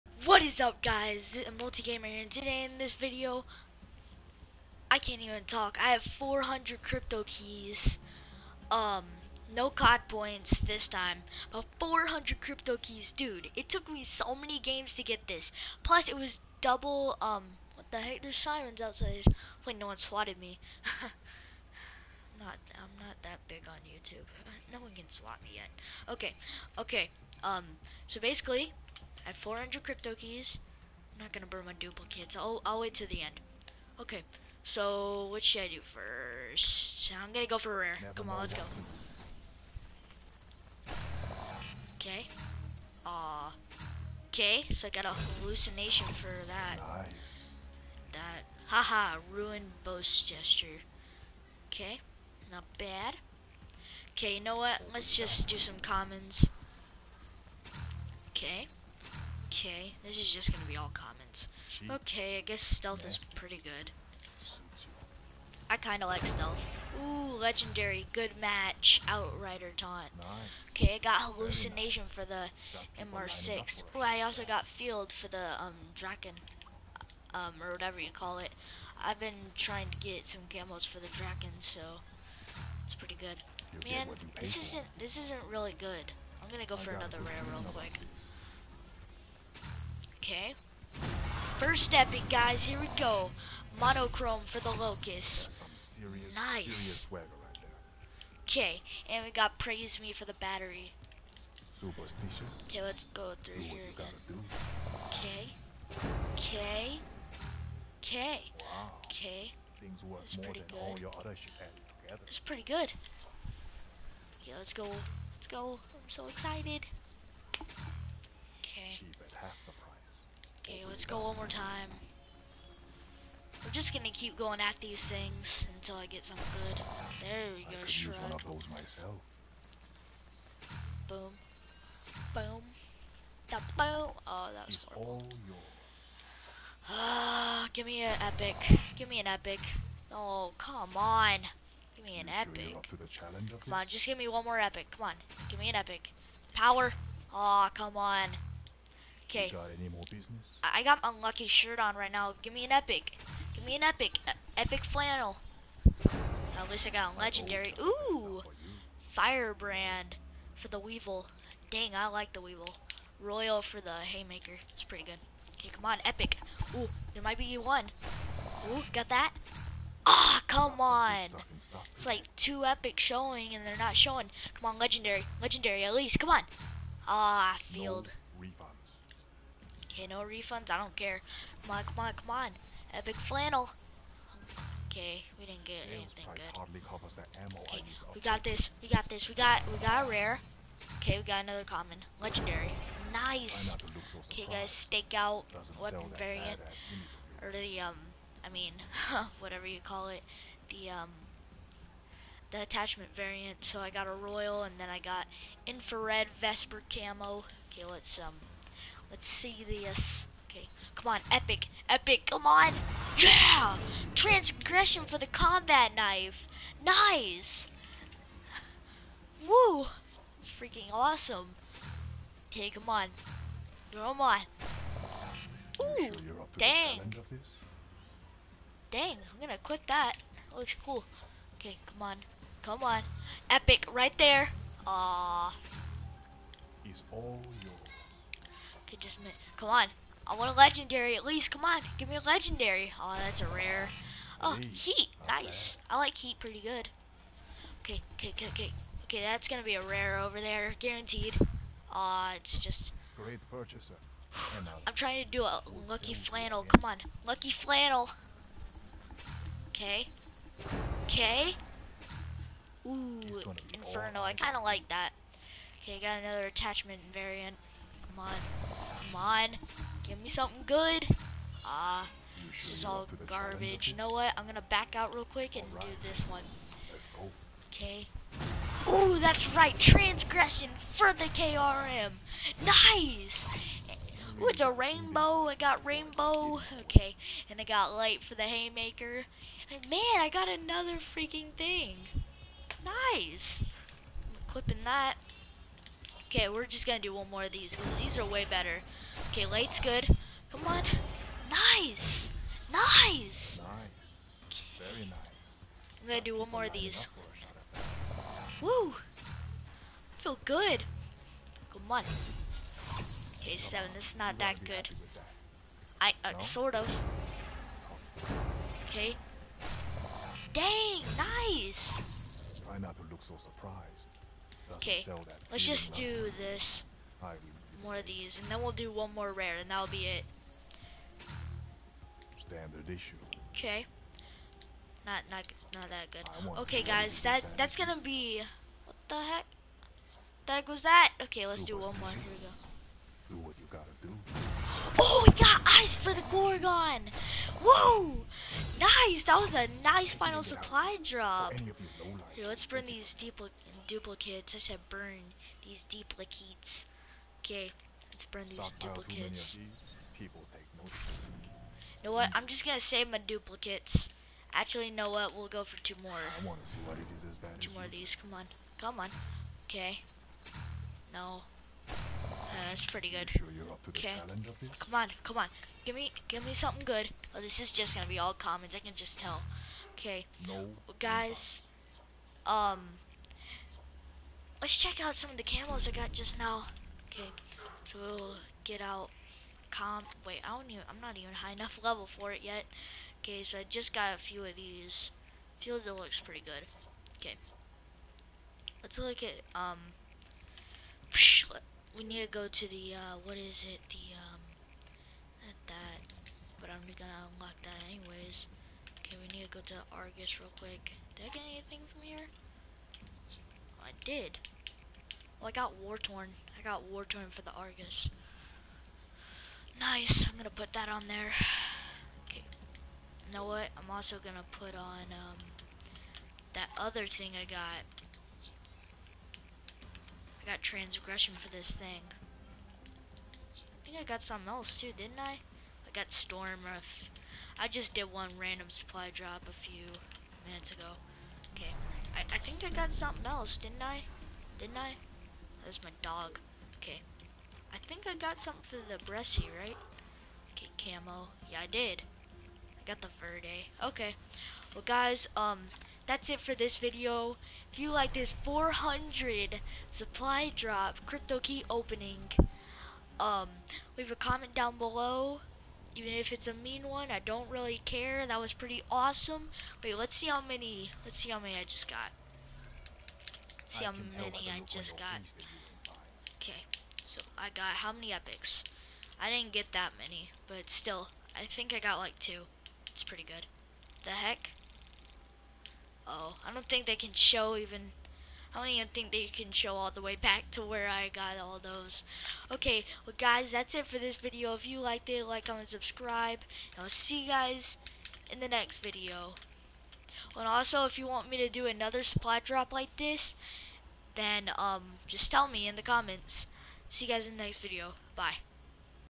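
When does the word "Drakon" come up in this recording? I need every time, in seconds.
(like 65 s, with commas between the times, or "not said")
75 s, 81 s.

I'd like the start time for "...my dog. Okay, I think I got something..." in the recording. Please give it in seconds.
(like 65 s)
445 s.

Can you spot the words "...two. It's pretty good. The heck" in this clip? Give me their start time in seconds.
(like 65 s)
482 s.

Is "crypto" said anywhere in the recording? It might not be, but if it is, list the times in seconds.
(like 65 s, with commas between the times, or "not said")
6 s, 12 s, 29 s, 461 s.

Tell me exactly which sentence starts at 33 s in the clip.
Okay, so what should I do first?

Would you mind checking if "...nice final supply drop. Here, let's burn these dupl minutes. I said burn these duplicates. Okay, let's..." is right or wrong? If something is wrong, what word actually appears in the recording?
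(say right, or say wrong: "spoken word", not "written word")
wrong: "duplicates", not "minutes".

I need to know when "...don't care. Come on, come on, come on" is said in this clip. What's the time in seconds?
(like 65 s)
180 s.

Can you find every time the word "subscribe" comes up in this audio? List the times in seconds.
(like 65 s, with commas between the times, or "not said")
495 s.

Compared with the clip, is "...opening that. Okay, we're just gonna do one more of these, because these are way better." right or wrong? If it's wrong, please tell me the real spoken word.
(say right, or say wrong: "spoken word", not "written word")
wrong: "clipping", not "opening".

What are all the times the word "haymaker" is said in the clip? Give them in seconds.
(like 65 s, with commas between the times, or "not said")
164 s, 288 s.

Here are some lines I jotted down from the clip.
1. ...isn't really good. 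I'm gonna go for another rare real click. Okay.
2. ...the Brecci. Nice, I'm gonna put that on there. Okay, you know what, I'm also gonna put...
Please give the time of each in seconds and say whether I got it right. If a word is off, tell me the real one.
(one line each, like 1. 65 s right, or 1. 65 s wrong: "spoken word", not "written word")
1. 85 s wrong: "quick", not "click"
2. 417 s wrong: "Argus", not "Brecci".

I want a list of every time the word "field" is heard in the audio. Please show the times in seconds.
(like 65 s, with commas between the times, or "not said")
74 s, 177 s.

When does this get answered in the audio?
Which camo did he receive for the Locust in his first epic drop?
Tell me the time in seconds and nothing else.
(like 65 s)
93 s.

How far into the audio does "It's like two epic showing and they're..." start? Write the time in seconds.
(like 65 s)
171 s.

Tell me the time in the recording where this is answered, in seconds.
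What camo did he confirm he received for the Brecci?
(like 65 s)
453 s.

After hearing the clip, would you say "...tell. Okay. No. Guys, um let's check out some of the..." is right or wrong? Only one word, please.
right.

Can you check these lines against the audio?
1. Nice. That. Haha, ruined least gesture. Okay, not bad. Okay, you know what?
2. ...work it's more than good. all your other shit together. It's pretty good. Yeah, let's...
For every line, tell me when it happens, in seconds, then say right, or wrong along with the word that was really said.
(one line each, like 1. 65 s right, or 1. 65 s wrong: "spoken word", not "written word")
1. 46 s wrong: "boast", not "least"
2. 110 s right.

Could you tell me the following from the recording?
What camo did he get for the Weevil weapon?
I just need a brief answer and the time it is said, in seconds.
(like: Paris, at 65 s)
Firebrand, at 159 s.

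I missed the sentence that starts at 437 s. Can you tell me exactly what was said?
I just did one random supply drop a few minutes ago.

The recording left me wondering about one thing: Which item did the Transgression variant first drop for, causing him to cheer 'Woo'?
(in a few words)
Combat knife.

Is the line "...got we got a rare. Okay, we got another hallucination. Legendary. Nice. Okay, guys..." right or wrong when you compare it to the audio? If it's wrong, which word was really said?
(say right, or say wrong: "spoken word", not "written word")
wrong: "common", not "hallucination".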